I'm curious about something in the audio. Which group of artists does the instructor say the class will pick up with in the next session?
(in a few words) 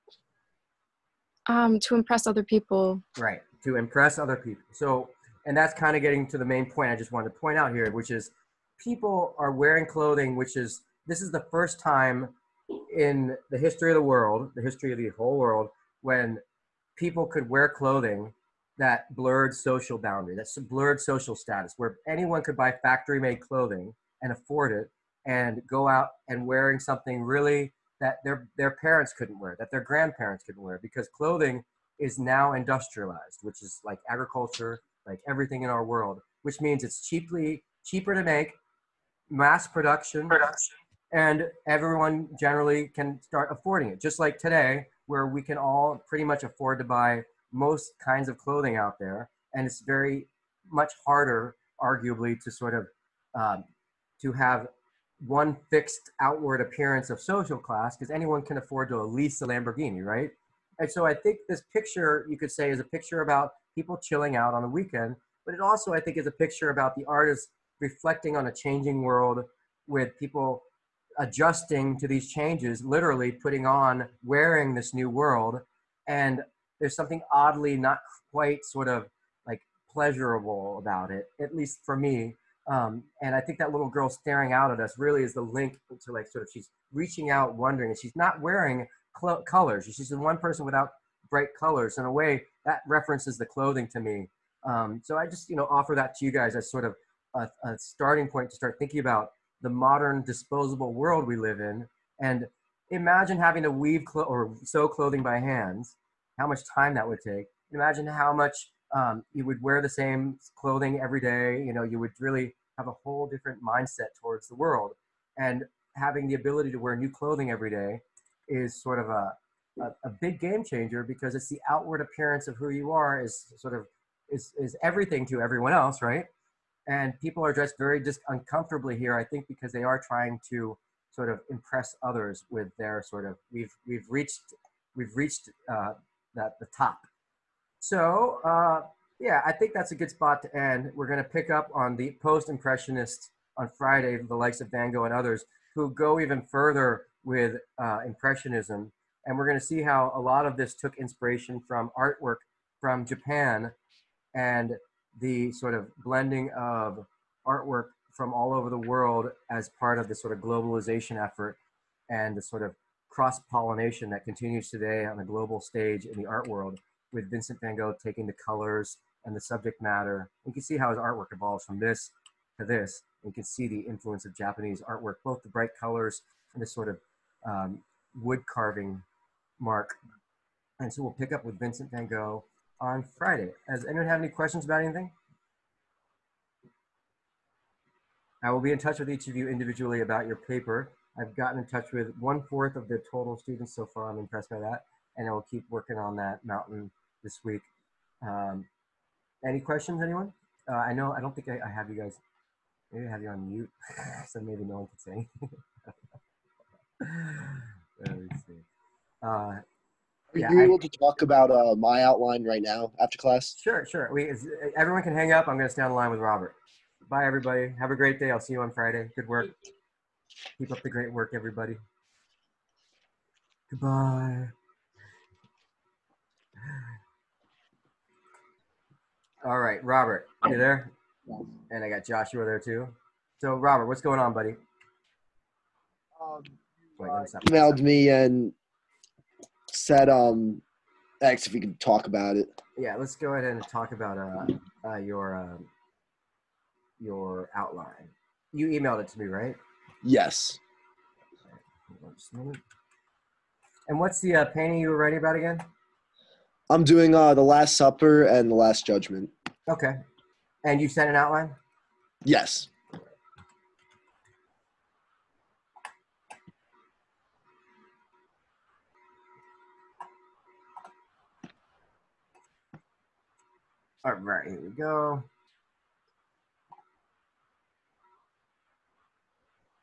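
post-impressionists.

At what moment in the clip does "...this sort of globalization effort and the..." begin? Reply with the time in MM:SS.
02:40.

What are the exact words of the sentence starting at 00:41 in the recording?
and everyone generally can start affording it.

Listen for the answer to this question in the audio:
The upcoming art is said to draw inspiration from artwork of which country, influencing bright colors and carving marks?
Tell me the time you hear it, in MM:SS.
02:33.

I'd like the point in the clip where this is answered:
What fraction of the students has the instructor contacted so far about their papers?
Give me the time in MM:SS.
03:12.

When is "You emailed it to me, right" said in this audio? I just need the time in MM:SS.
04:08.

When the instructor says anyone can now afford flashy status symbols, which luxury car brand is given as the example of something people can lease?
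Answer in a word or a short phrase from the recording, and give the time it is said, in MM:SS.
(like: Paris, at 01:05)
Lamborghini, at 00:59.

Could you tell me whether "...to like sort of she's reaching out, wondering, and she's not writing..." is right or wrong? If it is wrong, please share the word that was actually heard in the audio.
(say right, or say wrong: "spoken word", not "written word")
wrong: "wearing", not "writing".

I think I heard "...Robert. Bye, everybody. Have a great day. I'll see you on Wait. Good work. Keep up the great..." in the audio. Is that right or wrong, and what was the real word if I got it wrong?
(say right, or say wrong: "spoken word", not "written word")
wrong: "Friday", not "Wait".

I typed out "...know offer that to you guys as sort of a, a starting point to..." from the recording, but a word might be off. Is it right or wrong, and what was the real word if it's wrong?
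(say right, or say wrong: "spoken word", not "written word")
right.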